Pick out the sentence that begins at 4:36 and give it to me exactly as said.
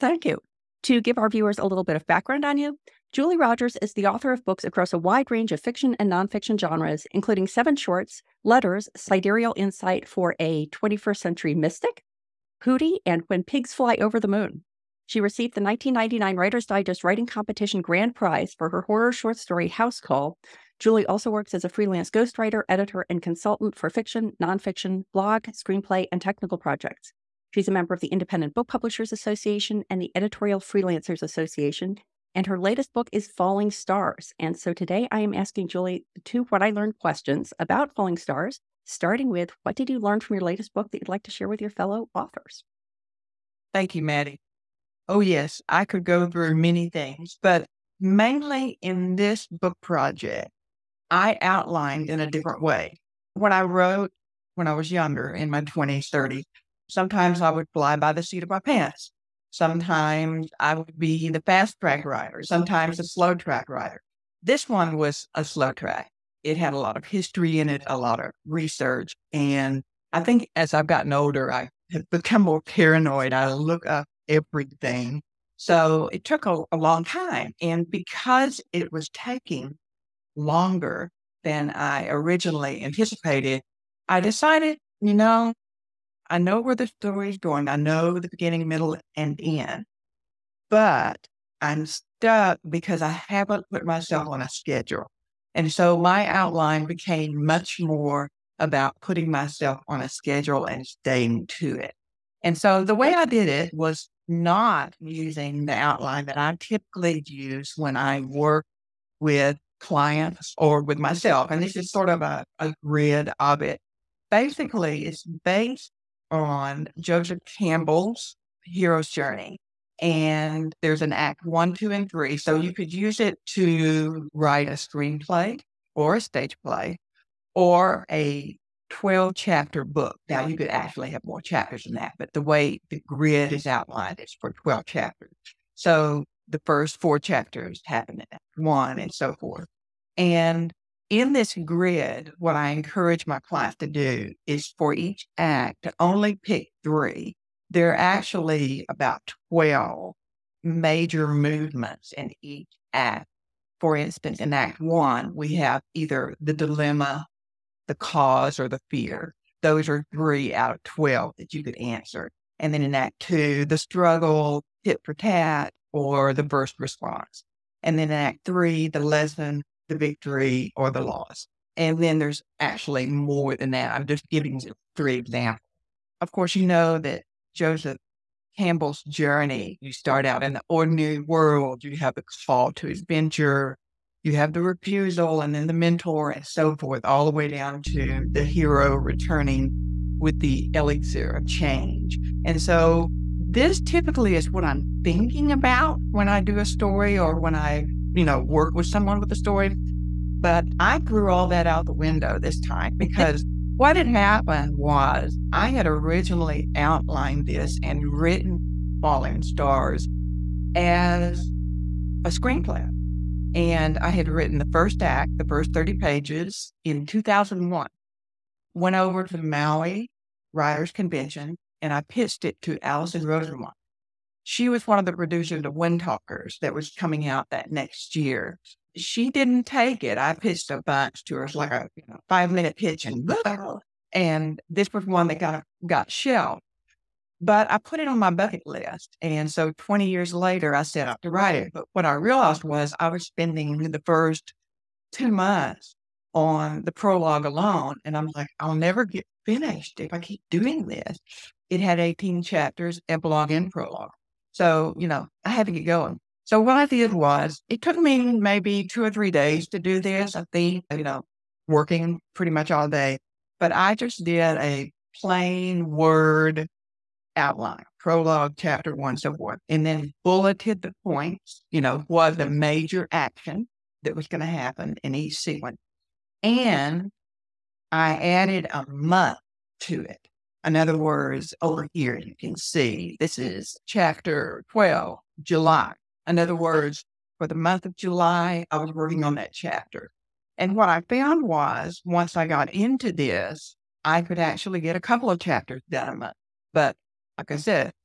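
And I added a month to it.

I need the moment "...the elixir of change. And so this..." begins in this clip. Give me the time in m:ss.
3:10.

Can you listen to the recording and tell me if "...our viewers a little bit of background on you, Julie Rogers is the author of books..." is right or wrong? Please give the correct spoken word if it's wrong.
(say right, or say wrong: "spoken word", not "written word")
right.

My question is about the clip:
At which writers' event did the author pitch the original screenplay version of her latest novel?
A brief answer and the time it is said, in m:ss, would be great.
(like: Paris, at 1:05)
Maui Writers Convention, at 3:39.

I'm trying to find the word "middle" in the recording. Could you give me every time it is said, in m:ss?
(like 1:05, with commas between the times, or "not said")
1:28.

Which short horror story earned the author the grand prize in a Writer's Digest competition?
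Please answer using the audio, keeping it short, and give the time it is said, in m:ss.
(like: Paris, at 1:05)
House Call, at 0:19.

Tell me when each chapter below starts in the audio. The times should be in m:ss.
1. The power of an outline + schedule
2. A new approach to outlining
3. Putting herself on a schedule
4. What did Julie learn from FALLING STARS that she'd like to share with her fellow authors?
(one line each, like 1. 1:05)
1. 4:15
2. 0:42
3. 1:16
4. 0:31.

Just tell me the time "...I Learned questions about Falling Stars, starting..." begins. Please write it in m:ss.
0:36.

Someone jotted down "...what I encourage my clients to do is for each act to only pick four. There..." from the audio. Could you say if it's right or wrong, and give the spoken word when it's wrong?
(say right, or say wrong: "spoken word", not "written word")
wrong: "three", not "four".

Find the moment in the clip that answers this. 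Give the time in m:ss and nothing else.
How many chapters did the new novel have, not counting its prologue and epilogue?
4:11.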